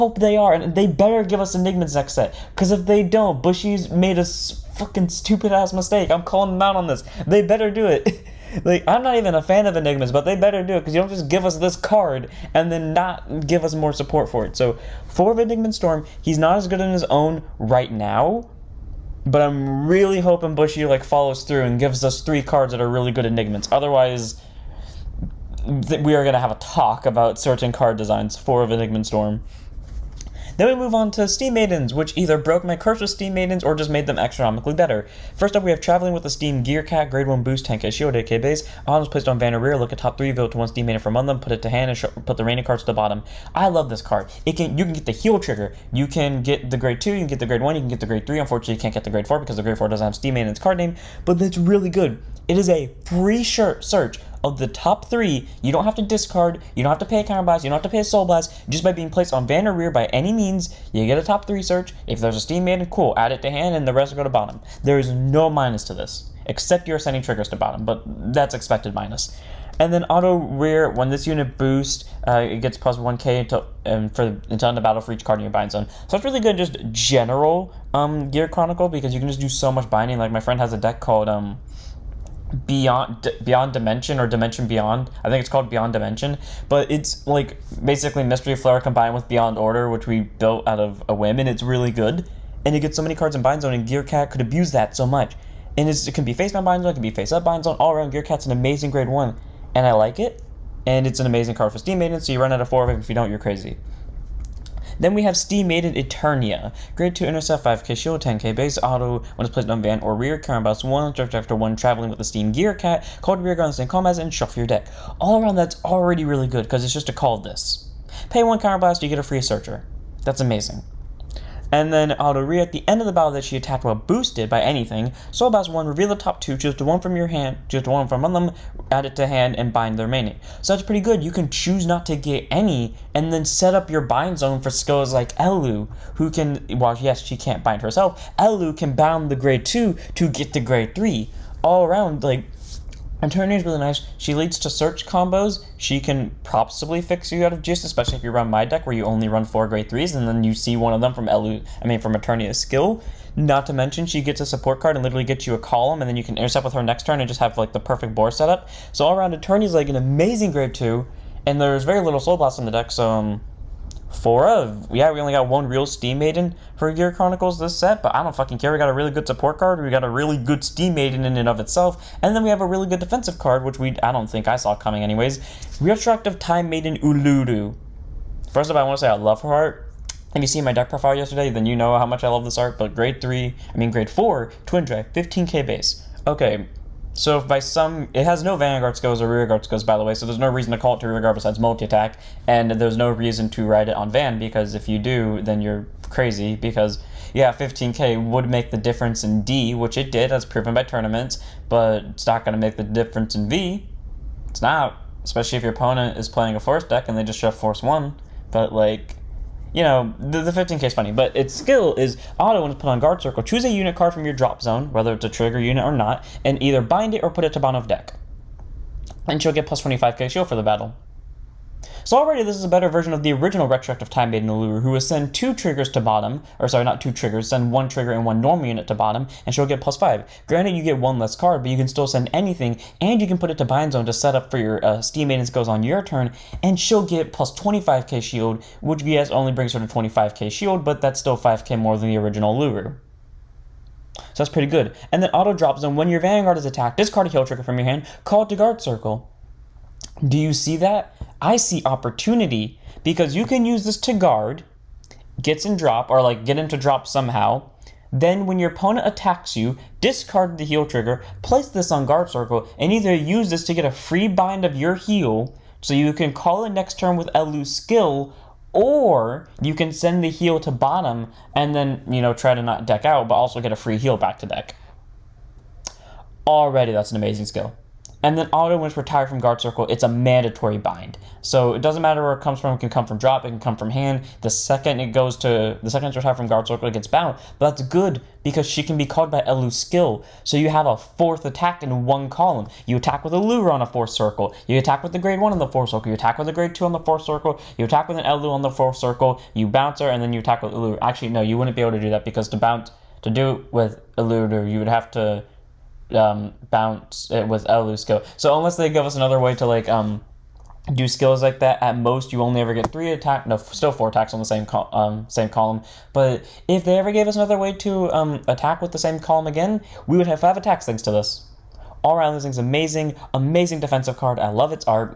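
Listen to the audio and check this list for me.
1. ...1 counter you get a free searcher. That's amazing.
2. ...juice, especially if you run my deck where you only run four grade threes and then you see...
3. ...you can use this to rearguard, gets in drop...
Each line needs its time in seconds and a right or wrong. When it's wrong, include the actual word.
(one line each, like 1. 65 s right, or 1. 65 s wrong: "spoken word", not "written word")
1. 118 s right
2. 147 s right
3. 253 s wrong: "guard", not "rearguard".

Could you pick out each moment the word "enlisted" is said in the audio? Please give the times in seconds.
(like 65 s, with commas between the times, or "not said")
not said.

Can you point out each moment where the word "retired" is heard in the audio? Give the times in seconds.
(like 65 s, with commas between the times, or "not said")
278 s, 286 s.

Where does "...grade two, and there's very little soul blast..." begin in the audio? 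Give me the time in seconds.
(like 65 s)
160 s.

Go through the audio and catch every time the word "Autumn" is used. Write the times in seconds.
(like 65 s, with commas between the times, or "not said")
38 s.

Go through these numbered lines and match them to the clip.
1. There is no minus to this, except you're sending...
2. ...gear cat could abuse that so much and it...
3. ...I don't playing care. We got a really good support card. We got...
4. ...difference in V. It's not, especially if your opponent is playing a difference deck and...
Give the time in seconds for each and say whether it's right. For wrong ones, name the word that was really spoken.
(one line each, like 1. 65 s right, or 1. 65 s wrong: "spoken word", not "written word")
1. 64 s right
2. 93 s right
3. 168 s wrong: "fucking", not "playing"
4. 202 s wrong: "force", not "difference".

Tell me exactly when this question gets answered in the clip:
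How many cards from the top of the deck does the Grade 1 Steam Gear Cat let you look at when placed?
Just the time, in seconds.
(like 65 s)
39 s.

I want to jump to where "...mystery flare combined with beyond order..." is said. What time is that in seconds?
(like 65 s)
88 s.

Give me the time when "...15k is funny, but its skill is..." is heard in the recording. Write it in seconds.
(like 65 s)
210 s.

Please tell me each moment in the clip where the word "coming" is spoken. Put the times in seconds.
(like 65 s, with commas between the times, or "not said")
174 s.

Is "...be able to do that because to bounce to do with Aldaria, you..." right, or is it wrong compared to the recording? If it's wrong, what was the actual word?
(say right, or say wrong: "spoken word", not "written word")
wrong: "Eluder", not "Aldaria".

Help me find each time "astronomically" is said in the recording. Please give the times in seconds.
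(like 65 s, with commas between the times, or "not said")
34 s.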